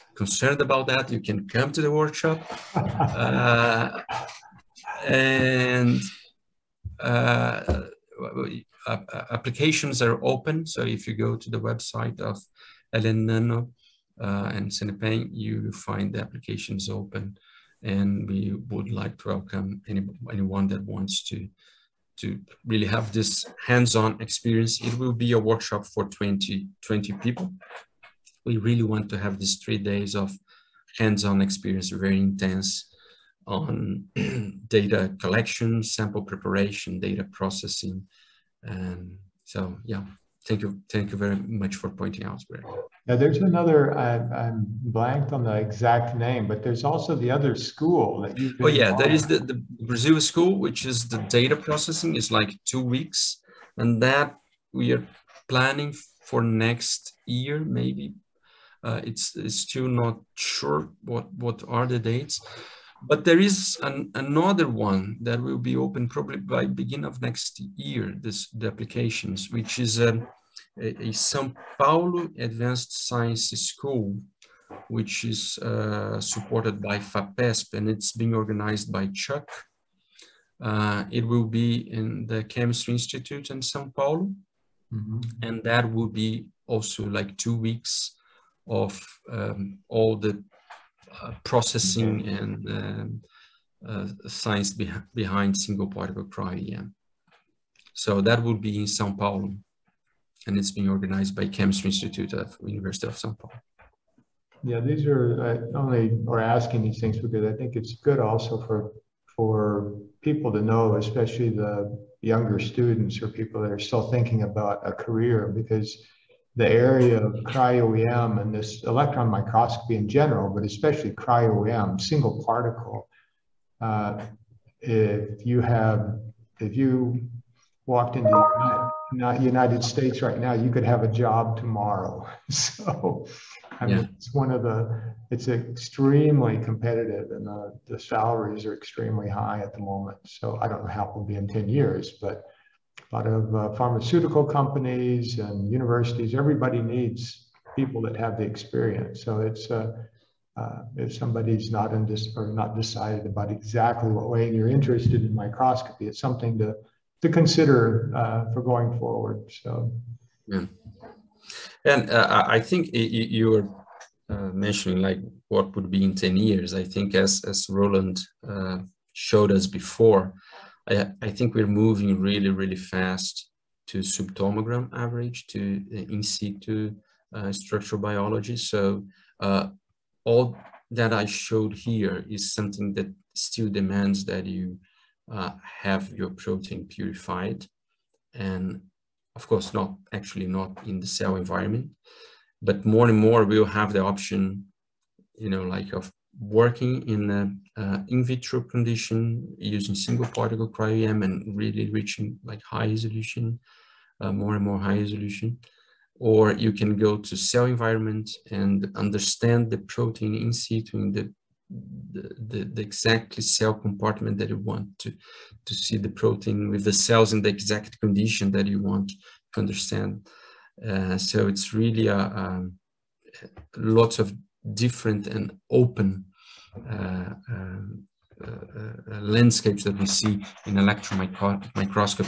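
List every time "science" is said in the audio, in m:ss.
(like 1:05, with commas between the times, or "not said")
1:13, 1:34.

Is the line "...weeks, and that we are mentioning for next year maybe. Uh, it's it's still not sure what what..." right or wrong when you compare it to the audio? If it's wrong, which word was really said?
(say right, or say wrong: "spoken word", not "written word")
wrong: "planning", not "mentioning".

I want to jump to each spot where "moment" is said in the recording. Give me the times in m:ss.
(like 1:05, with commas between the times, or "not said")
2:19.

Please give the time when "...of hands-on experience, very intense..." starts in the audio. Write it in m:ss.
0:30.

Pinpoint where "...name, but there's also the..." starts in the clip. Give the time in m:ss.
0:46.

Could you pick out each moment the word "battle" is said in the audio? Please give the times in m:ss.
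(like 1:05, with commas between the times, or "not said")
not said.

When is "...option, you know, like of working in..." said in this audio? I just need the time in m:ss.
3:14.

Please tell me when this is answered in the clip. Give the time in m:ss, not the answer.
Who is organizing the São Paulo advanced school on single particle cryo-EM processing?
1:19.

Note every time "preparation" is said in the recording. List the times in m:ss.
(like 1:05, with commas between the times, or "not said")
0:36.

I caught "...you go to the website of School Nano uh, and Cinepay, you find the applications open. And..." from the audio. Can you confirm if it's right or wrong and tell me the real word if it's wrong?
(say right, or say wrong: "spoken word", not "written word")
wrong: "Ellen", not "School".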